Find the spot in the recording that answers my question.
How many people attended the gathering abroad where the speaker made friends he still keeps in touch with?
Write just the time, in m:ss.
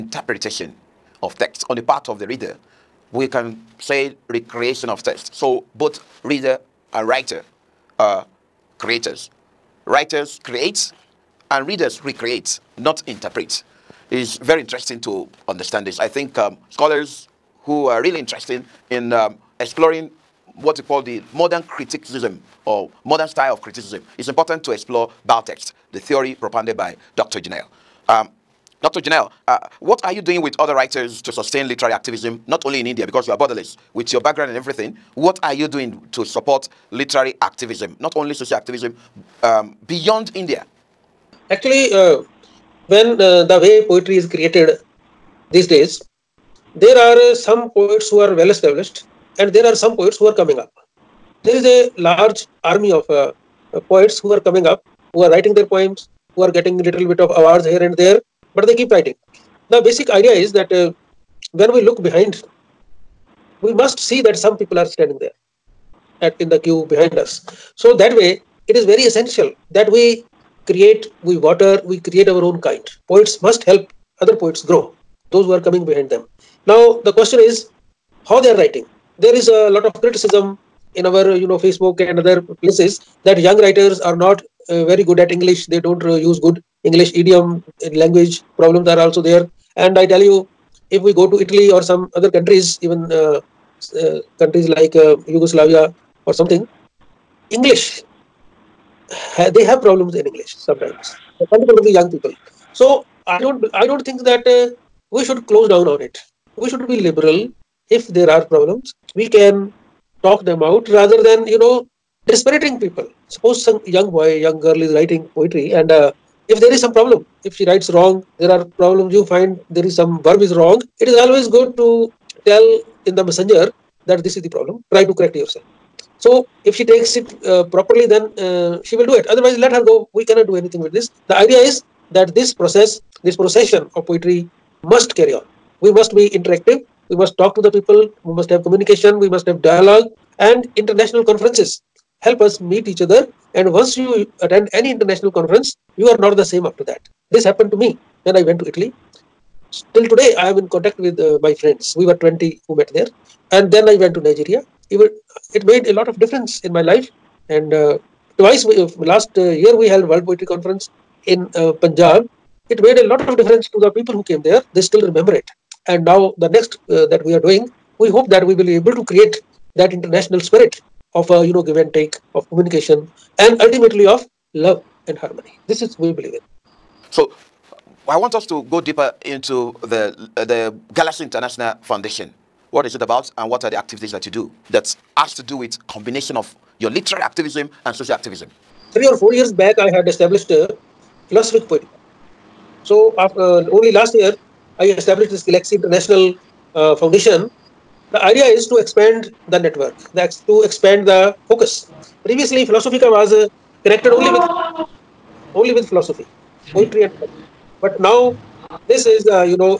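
2:32.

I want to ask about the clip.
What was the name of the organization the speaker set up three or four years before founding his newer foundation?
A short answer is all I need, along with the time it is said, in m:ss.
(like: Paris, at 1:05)
Philosophic Poetica, at 3:11.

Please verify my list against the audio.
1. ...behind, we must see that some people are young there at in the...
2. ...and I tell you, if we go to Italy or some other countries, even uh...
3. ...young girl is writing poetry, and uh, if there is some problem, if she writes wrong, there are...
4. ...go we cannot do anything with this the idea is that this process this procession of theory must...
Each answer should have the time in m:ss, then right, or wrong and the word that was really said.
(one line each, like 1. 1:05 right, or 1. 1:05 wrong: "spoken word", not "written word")
1. 1:02 wrong: "standing", not "young"
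2. 1:29 right
3. 1:54 right
4. 2:09 wrong: "poetry", not "theory".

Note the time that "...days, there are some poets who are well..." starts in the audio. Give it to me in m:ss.
0:45.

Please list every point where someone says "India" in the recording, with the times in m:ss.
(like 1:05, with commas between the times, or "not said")
0:32, 0:40.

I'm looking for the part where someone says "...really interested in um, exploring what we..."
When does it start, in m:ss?
0:18.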